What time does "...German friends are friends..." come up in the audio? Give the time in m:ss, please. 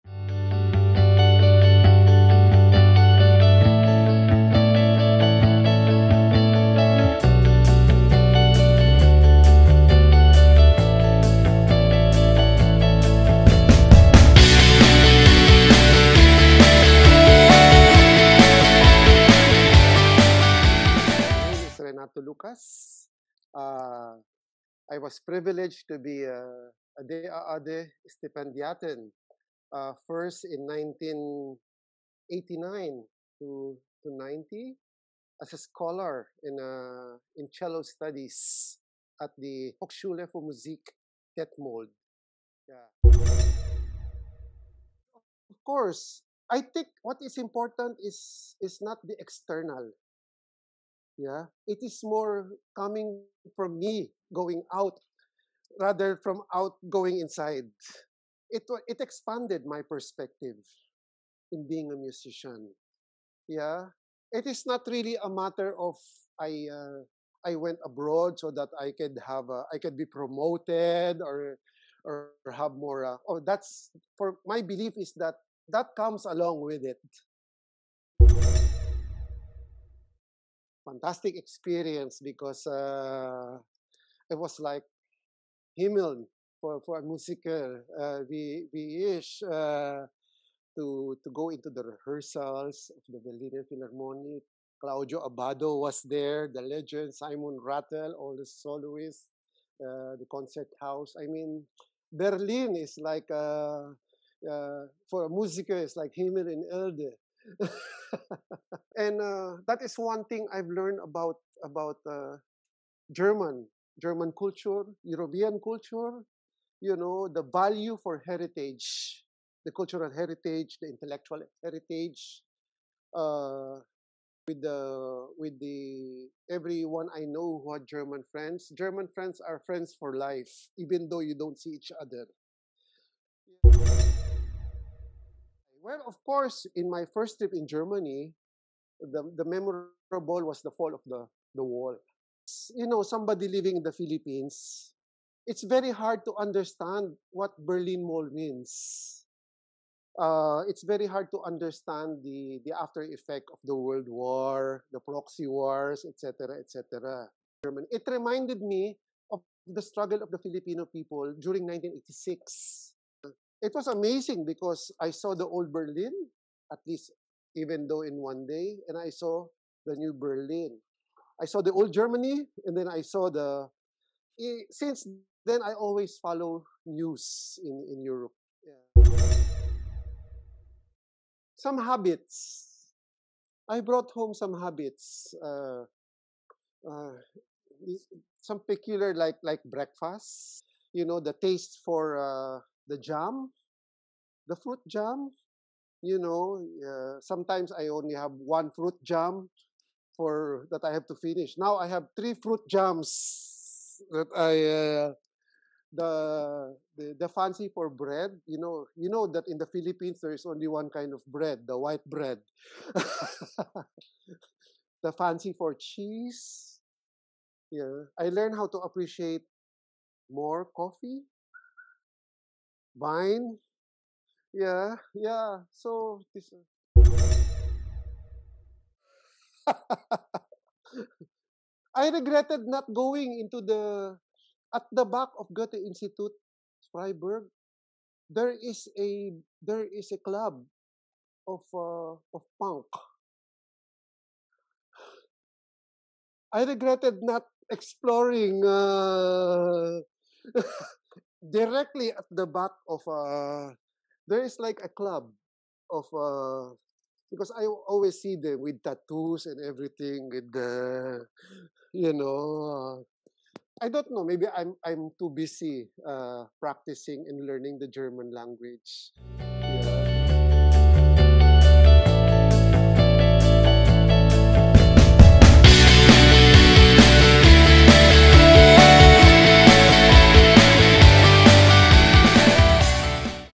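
2:08.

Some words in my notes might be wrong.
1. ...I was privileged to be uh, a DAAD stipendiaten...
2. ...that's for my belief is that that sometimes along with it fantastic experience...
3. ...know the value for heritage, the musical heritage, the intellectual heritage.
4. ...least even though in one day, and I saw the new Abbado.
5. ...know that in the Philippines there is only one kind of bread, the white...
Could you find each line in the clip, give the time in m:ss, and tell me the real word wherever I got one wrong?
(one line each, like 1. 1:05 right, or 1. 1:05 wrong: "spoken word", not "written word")
1. 0:24 right
2. 1:13 wrong: "comes", not "sometimes"
3. 1:56 wrong: "cultural", not "musical"
4. 2:46 wrong: "Berlin", not "Abbado"
5. 3:29 right.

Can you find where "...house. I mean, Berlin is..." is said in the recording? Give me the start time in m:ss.
1:40.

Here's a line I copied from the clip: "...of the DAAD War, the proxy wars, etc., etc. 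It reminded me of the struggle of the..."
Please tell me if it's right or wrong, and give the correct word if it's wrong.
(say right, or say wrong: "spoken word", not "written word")
wrong: "World", not "DAAD".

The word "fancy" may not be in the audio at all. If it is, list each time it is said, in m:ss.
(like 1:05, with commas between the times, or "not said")
3:27, 3:35.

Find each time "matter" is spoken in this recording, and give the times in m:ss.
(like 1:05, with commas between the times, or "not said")
1:05.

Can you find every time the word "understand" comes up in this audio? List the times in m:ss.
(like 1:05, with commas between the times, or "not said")
2:26, 2:31.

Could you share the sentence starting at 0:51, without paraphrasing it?
It is more coming from me going out rather from out going inside.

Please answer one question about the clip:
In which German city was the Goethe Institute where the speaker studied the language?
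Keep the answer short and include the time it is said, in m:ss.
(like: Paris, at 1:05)
Freiburg, at 3:56.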